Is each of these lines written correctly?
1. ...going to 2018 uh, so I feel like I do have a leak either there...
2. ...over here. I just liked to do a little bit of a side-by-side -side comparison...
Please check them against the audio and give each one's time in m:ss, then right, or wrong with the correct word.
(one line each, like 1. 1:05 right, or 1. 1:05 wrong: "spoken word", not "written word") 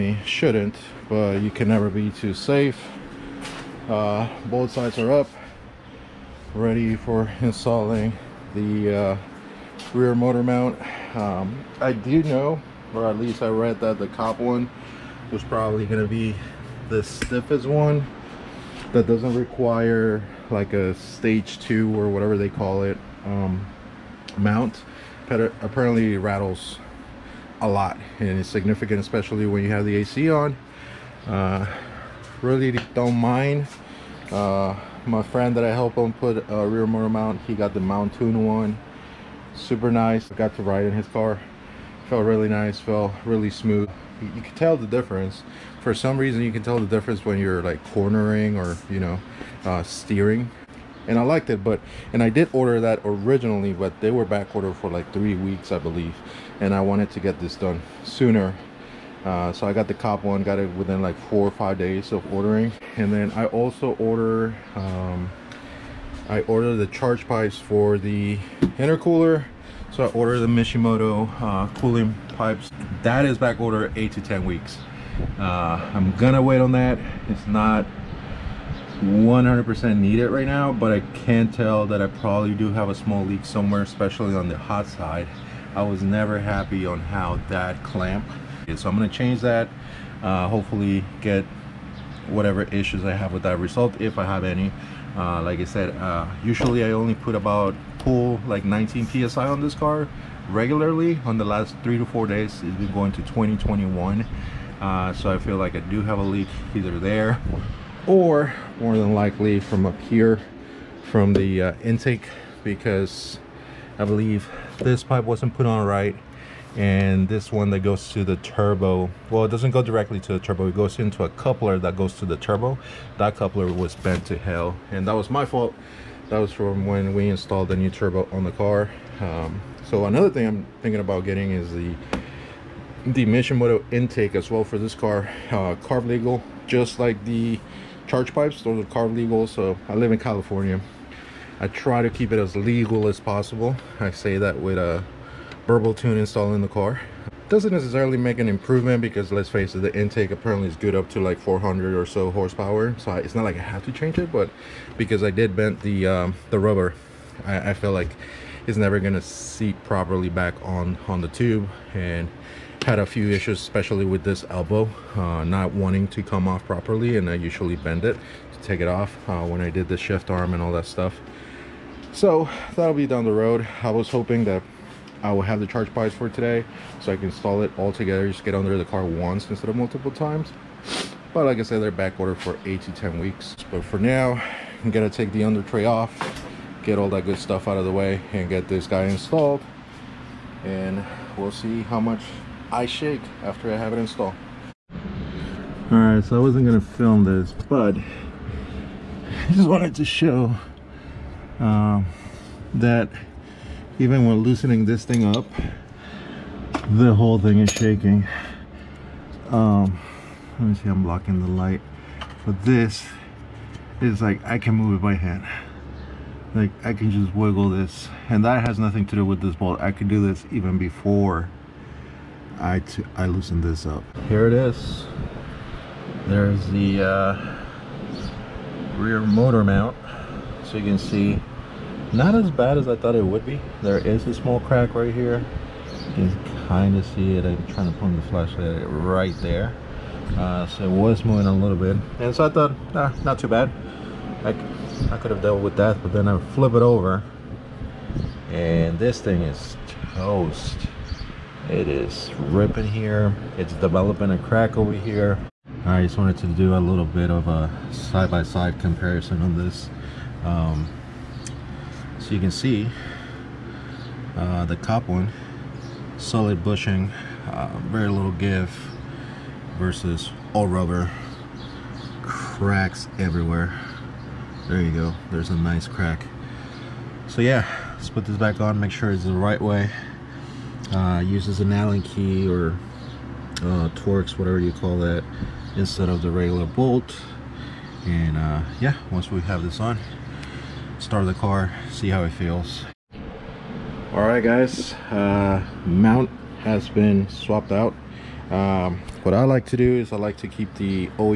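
1. 1:42 wrong: "2021", not "2018"
2. 4:14 wrong: "wanted", not "liked".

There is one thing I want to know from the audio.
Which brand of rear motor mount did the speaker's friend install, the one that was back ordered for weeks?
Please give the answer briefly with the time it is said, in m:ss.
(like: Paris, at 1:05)
Mountain, at 0:37.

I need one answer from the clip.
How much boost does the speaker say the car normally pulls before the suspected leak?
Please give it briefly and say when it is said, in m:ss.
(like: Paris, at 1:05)
19 psi, at 1:38.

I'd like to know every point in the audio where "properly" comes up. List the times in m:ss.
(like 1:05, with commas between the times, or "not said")
2:39, 2:46.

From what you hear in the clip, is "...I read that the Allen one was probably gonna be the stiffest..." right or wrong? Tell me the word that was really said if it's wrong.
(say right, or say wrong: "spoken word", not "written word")
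wrong: "Cobb", not "Allen".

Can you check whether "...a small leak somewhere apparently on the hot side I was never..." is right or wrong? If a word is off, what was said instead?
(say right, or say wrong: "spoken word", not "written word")
wrong: "especially", not "apparently".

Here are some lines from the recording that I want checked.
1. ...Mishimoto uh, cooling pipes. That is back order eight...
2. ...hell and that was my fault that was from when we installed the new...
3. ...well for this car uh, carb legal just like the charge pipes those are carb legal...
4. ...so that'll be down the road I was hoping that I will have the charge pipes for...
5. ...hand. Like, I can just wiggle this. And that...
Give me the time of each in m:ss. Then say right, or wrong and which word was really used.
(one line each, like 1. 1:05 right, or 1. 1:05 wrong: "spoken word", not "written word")
1. 1:10 right
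2. 2:04 right
3. 2:14 right
4. 2:52 right
5. 3:35 right.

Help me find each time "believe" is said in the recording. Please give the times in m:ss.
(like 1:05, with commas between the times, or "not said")
0:55, 1:54.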